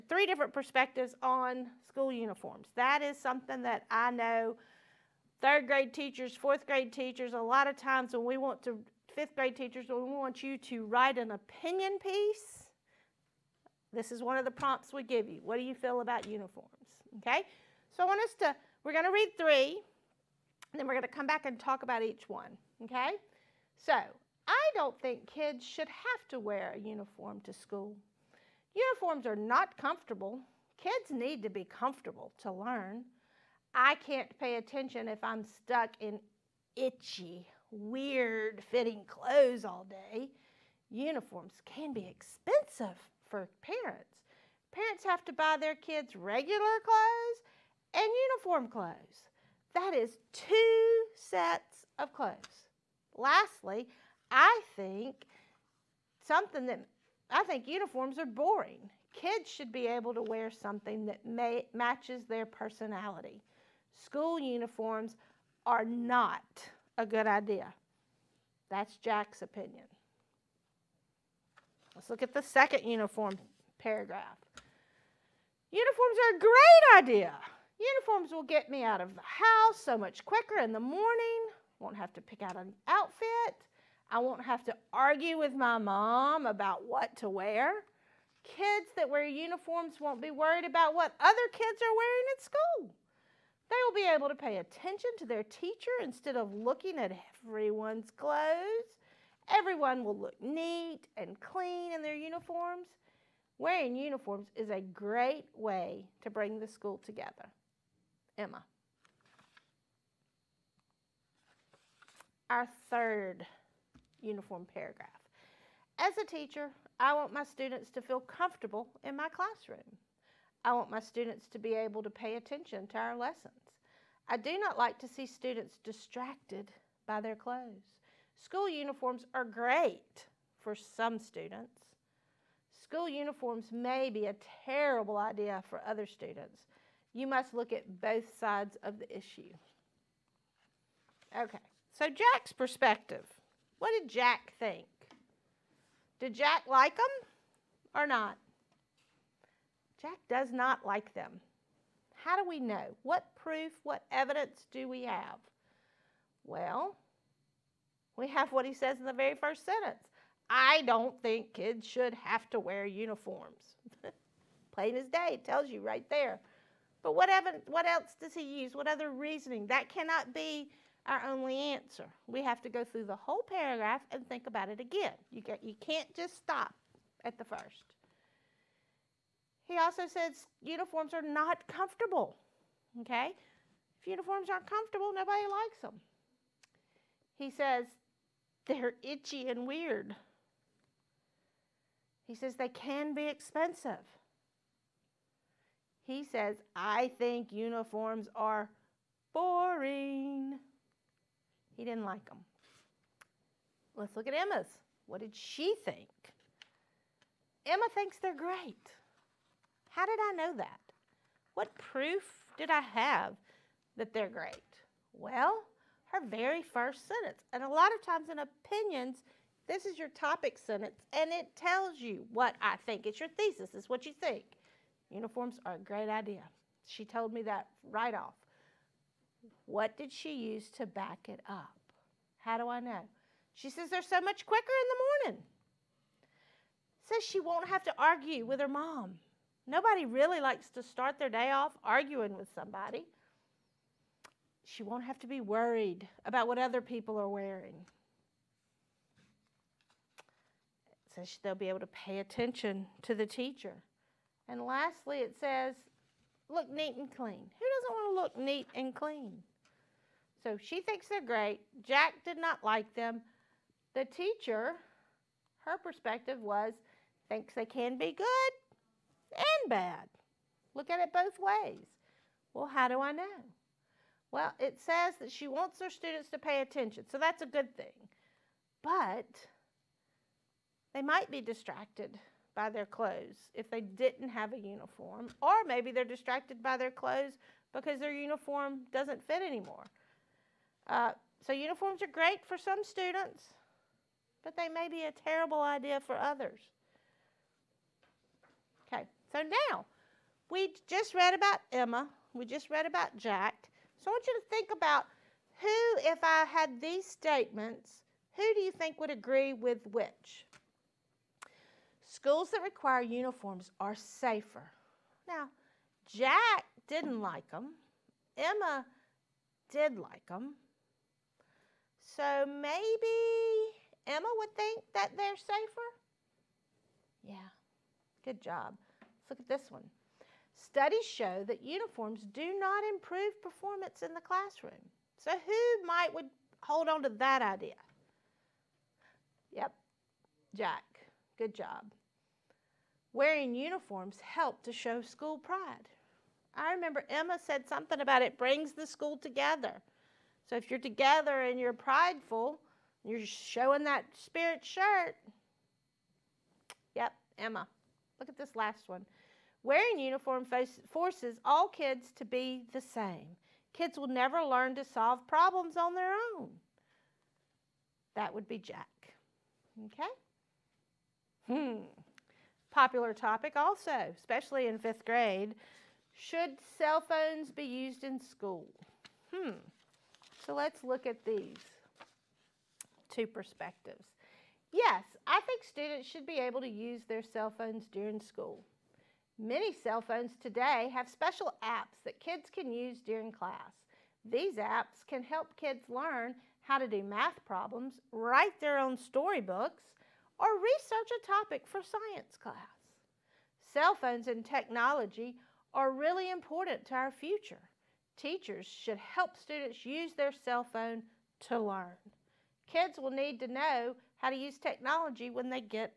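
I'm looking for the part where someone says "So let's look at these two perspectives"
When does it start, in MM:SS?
06:20.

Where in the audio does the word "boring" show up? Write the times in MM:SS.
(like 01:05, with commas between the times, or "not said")
00:58, 03:19.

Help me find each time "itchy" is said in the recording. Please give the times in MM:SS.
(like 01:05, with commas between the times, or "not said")
00:36, 03:09.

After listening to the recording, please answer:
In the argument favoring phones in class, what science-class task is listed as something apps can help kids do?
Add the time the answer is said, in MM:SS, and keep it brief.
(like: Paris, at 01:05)
Research a topic, at 06:40.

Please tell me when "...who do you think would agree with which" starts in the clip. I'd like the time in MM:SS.
05:08.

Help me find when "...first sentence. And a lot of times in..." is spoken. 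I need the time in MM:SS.
03:36.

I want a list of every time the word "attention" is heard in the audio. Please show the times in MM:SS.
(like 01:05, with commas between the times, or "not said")
00:34, 01:34, 02:02, 04:12, 04:36.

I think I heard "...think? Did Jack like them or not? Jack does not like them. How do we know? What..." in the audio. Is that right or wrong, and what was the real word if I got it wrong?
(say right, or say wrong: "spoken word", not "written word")
right.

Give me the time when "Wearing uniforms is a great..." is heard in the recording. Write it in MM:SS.
01:43.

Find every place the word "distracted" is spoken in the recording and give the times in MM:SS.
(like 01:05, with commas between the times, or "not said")
02:05, 04:41, 04:46.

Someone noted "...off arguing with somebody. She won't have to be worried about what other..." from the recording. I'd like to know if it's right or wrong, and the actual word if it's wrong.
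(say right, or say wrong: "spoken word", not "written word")
right.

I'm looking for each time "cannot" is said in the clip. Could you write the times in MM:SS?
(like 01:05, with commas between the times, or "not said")
02:49.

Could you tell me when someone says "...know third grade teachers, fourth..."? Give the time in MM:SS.
00:04.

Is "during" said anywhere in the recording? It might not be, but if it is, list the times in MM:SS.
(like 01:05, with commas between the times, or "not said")
06:27, 06:33.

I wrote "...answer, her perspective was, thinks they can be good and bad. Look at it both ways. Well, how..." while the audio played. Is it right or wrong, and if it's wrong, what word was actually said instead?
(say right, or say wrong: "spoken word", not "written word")
wrong: "teacher", not "answer".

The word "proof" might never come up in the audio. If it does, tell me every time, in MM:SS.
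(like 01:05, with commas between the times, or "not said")
02:33, 03:31.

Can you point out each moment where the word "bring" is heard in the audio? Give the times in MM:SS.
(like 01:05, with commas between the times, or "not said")
01:46, 05:48.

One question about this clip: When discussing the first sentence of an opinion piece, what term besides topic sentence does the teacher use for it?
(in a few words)
Thesis.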